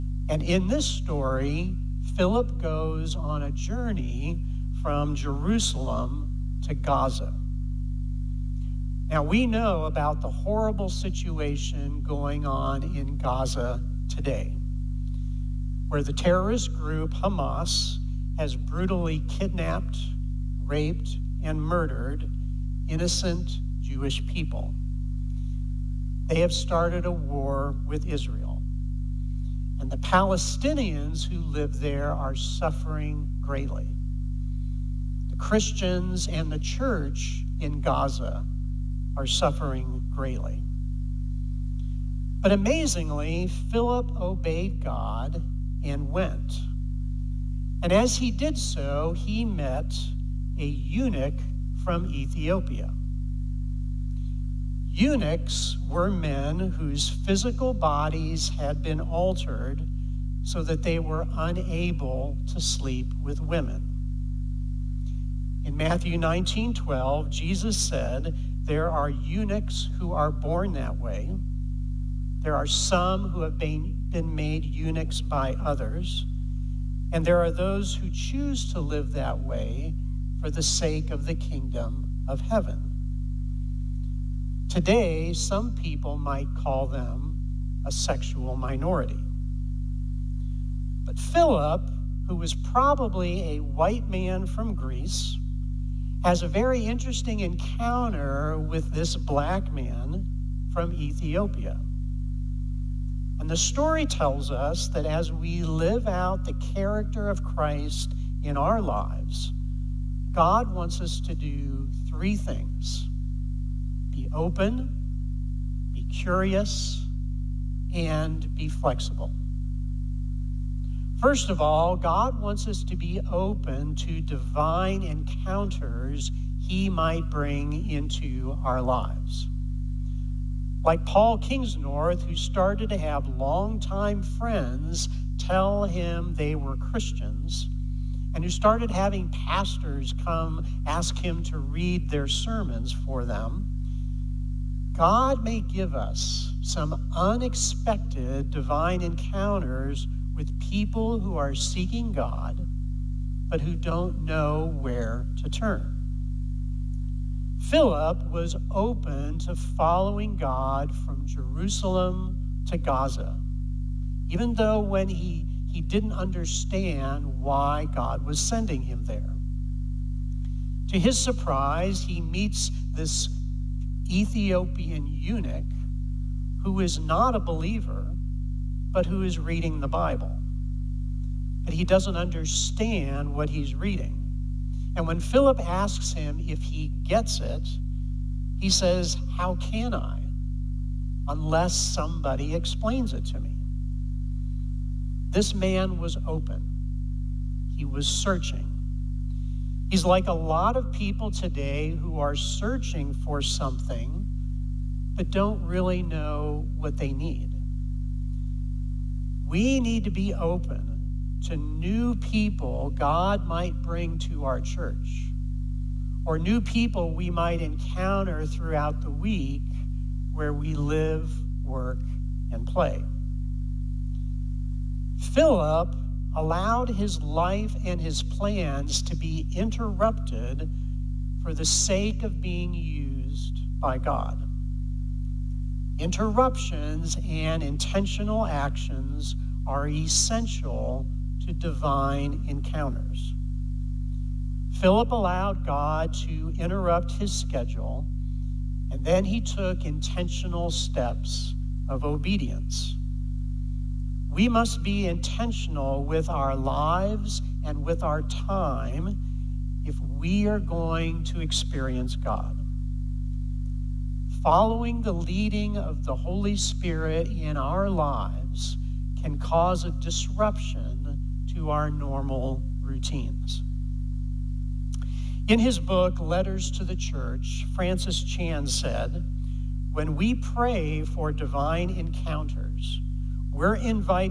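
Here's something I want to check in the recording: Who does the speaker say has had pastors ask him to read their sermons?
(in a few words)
Paul Kingsnorth.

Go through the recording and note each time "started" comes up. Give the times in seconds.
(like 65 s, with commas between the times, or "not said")
26 s, 132 s, 138 s.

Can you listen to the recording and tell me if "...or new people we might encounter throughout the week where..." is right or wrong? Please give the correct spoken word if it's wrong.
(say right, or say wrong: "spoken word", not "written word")
right.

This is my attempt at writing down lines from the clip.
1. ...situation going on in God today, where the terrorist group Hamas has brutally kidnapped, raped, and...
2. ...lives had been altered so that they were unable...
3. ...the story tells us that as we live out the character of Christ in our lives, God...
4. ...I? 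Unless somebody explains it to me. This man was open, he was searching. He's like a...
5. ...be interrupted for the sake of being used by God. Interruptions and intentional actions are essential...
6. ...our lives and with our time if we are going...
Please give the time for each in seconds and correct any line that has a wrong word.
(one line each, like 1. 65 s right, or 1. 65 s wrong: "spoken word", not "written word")
1. 10 s wrong: "Gaza", not "God"
2. 57 s wrong: "bodies", not "lives"
3. 103 s right
4. 189 s right
5. 229 s right
6. 256 s right.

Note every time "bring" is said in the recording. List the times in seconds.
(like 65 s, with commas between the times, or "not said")
127 s, 213 s.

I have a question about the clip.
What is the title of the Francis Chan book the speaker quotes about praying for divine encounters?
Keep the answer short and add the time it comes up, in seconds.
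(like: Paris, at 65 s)
Letters to the Church, at 276 s.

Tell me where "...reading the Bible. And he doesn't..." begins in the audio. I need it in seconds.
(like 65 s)
179 s.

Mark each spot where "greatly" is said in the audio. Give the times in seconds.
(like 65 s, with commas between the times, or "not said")
33 s, 40 s.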